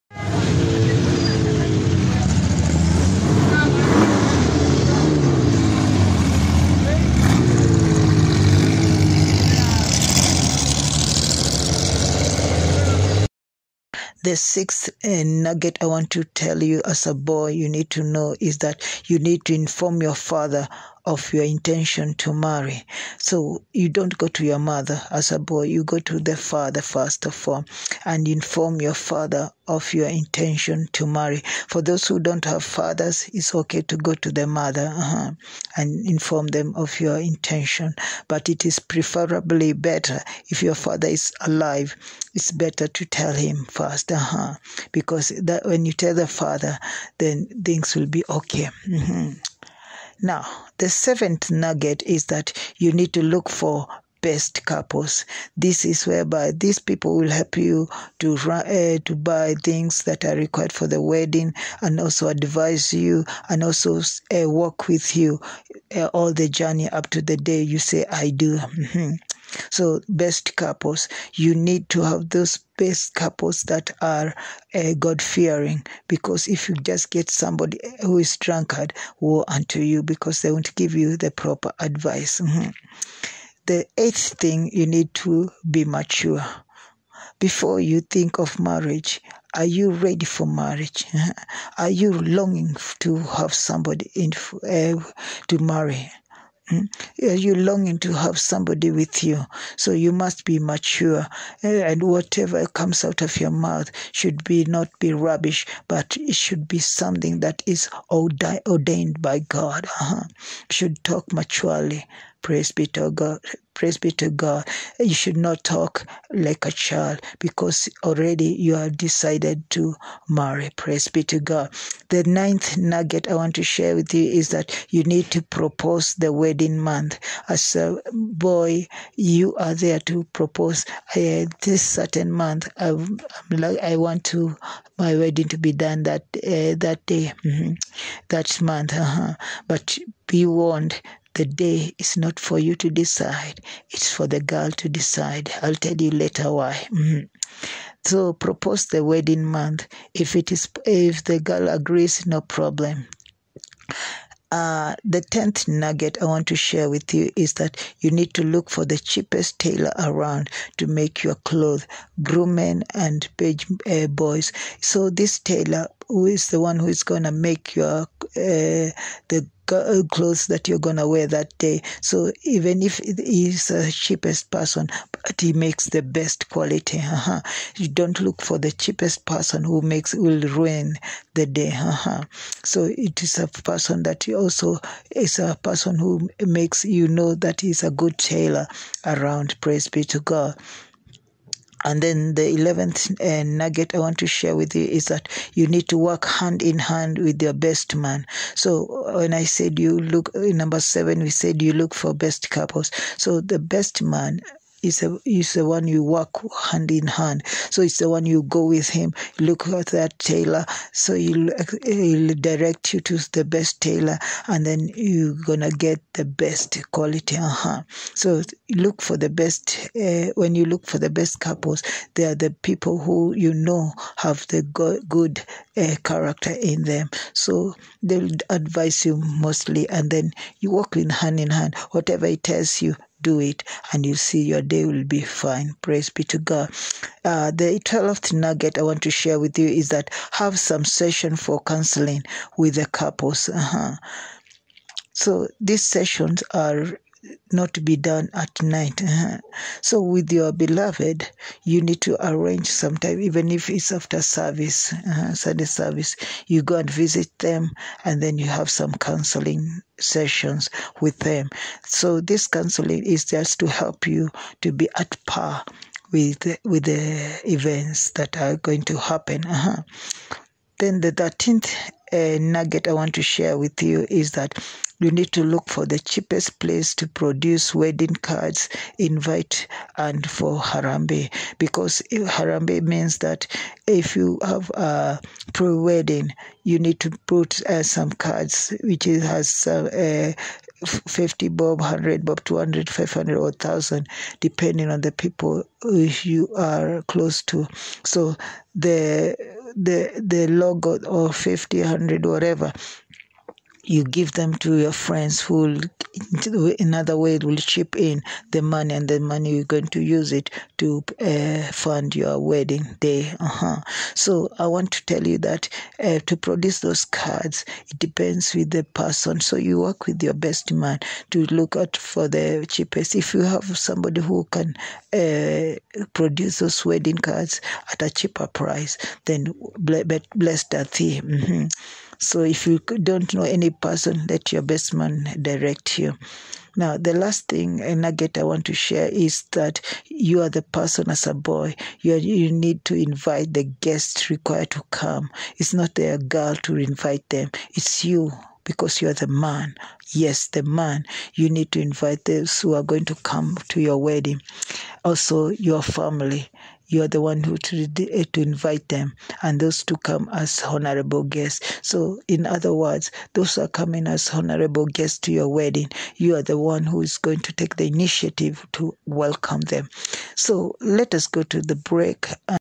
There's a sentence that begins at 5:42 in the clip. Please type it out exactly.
You, are, you need to invite the guests required to come.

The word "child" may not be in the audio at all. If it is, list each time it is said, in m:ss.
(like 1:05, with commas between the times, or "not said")
1:56.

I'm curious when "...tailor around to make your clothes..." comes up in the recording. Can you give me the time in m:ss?
2:39.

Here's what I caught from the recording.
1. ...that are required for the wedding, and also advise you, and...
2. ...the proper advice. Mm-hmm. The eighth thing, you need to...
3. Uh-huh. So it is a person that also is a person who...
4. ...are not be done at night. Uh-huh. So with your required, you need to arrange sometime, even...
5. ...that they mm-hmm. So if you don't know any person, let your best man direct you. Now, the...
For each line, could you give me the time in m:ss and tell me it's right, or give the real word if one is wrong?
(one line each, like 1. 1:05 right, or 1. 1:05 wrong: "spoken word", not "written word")
1. 1:00 right
2. 1:21 right
3. 3:01 right
4. 4:06 wrong: "beloved", not "required"
5. 5:30 right.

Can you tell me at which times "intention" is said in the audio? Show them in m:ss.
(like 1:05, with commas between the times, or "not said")
0:21, 0:30, 0:37.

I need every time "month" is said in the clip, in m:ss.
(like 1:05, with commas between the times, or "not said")
2:06, 2:12, 2:18, 2:29.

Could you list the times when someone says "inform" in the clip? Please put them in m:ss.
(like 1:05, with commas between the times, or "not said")
0:19, 0:28, 0:36.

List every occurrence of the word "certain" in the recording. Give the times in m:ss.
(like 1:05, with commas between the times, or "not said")
2:11.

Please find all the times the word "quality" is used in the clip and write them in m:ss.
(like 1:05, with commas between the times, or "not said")
2:56, 3:36.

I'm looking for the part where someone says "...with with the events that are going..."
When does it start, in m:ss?
4:26.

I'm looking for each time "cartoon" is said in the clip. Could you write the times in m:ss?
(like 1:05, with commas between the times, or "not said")
not said.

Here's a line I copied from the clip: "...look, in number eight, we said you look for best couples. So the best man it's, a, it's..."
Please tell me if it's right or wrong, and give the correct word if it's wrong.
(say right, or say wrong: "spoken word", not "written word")
wrong: "seven", not "eight".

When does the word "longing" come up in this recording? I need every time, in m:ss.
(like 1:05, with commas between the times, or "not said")
1:32, 1:37.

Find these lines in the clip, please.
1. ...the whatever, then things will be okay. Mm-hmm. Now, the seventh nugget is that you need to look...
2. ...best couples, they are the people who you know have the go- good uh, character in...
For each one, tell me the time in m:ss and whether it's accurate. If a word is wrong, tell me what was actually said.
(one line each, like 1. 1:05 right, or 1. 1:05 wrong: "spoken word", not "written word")
1. 0:46 wrong: "father", not "whatever"
2. 3:41 right.